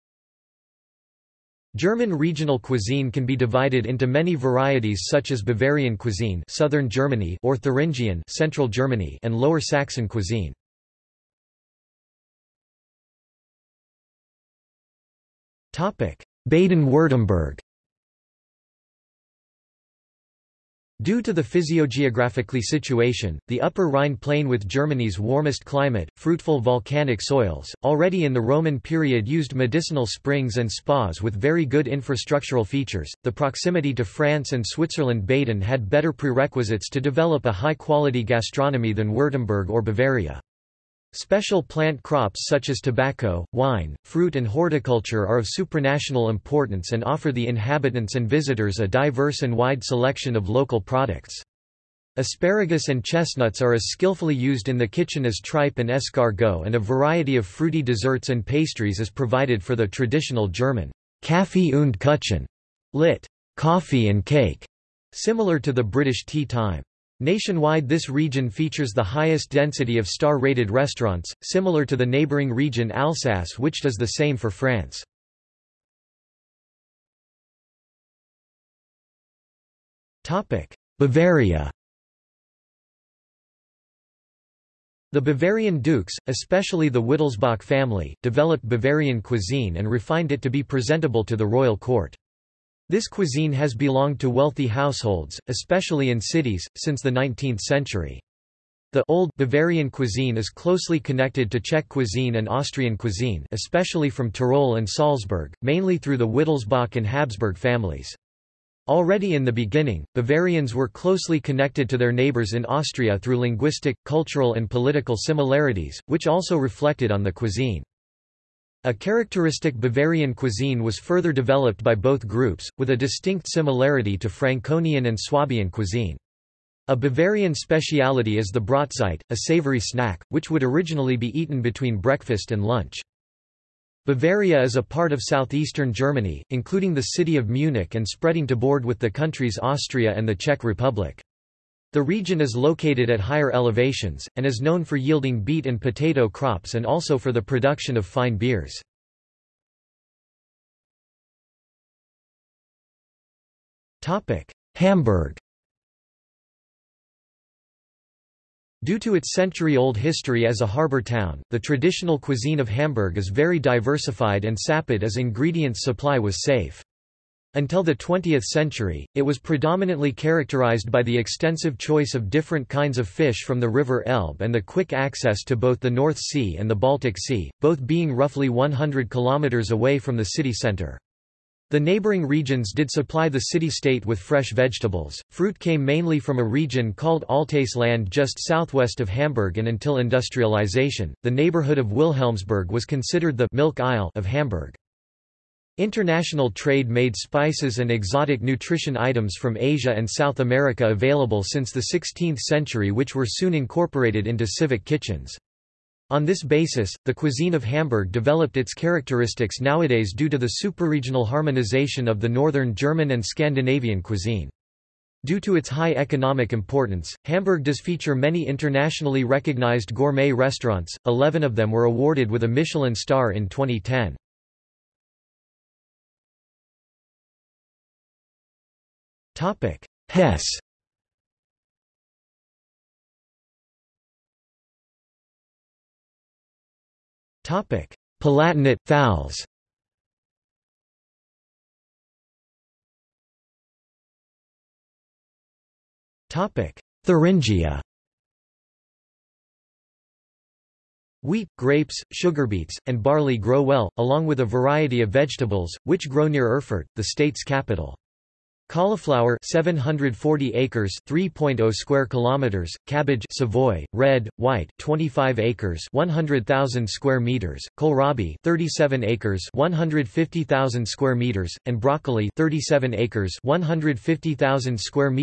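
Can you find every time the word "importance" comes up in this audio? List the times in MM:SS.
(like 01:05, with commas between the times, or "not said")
00:46, 03:36.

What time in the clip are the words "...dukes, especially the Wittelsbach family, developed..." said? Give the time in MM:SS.
01:25.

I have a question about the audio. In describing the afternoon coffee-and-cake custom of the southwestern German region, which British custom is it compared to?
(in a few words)
tea time.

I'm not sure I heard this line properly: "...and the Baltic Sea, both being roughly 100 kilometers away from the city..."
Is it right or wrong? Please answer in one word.
right.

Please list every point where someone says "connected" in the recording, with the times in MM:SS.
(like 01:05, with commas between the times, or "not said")
01:40, 01:51.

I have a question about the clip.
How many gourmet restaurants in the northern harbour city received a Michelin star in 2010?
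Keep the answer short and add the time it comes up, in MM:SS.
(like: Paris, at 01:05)
11, at 03:41.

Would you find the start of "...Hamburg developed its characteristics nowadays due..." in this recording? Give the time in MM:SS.
03:27.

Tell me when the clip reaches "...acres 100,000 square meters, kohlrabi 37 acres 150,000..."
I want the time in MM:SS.
04:25.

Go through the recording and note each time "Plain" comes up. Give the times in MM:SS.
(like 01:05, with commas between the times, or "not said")
00:24.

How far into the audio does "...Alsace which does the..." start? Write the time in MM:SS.
01:12.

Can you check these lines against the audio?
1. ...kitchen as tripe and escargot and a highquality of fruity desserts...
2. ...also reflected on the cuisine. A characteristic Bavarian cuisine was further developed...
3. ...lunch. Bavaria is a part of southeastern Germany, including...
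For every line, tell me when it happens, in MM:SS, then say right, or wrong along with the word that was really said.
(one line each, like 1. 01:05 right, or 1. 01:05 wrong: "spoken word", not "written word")
1. 00:54 wrong: "variety", not "highquality"
2. 01:56 right
3. 02:12 right.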